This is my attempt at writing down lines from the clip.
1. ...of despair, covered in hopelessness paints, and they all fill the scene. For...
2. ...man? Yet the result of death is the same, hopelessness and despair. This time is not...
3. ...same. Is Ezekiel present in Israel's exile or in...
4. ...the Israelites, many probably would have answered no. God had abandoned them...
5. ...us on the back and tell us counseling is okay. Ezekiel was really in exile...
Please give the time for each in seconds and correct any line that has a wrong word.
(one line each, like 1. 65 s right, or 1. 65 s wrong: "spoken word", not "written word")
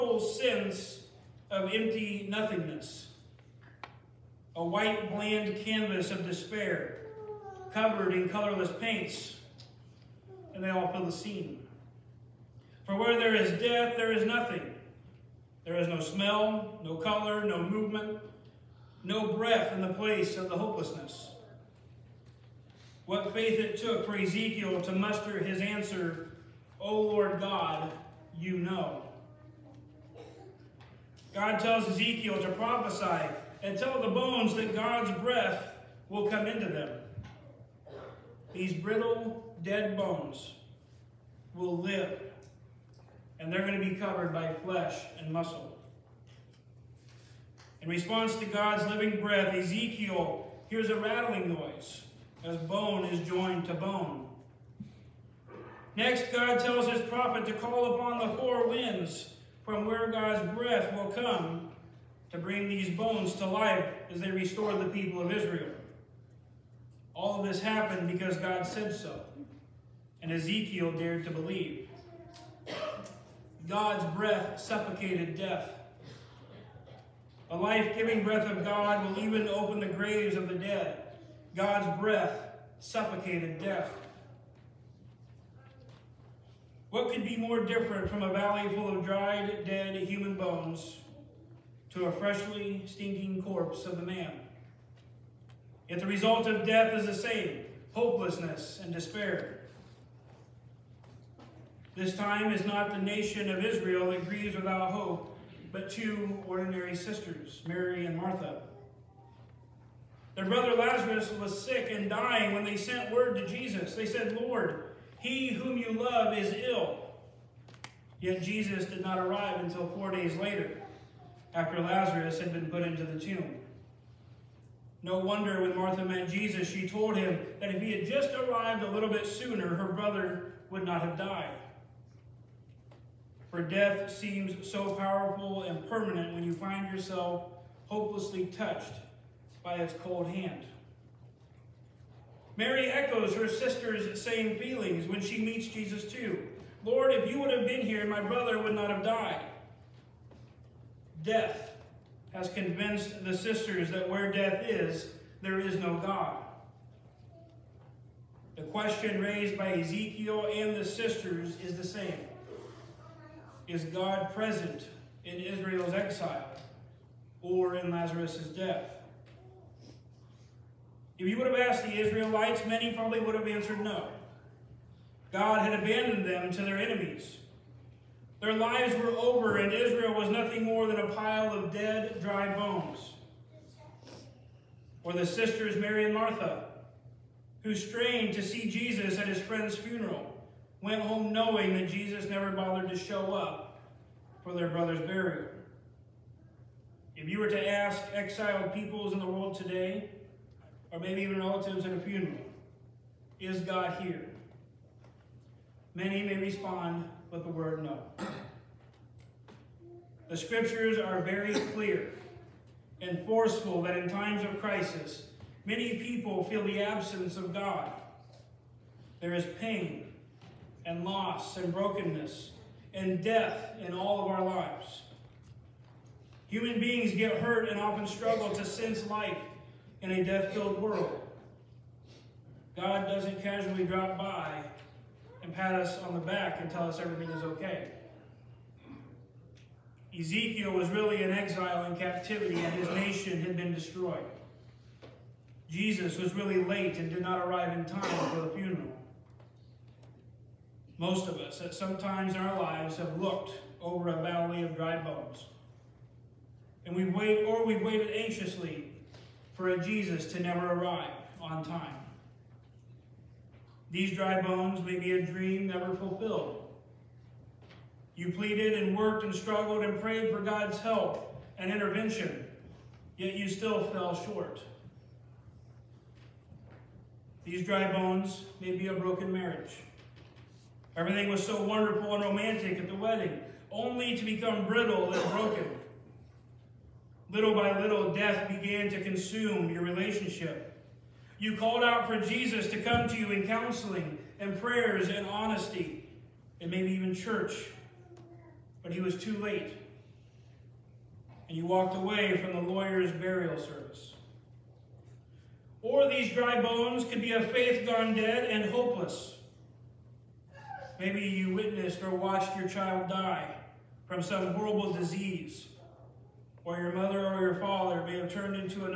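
1. 6 s wrong: "colorless", not "hopelessness"
2. 94 s right
3. 161 s wrong: "God", not "Ezekiel"
4. 171 s right
5. 235 s wrong: "everything", not "counseling".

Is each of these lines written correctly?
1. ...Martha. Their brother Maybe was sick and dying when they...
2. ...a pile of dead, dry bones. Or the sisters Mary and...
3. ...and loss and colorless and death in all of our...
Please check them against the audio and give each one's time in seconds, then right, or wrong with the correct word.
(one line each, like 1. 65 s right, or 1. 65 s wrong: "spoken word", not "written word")
1. 108 s wrong: "Lazarus", not "Maybe"
2. 180 s right
3. 220 s wrong: "brokenness", not "colorless".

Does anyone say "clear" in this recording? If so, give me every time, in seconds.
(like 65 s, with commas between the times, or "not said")
211 s.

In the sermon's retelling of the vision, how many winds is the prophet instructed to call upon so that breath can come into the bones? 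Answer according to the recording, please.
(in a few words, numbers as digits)
4.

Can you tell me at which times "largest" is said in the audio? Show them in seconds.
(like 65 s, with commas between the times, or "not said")
not said.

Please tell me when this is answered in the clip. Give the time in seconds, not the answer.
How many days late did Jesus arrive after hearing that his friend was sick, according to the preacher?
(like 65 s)
119 s.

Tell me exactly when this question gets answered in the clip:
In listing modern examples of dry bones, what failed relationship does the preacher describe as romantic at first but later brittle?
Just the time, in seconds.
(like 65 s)
278 s.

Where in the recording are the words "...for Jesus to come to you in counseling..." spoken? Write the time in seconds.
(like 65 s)
292 s.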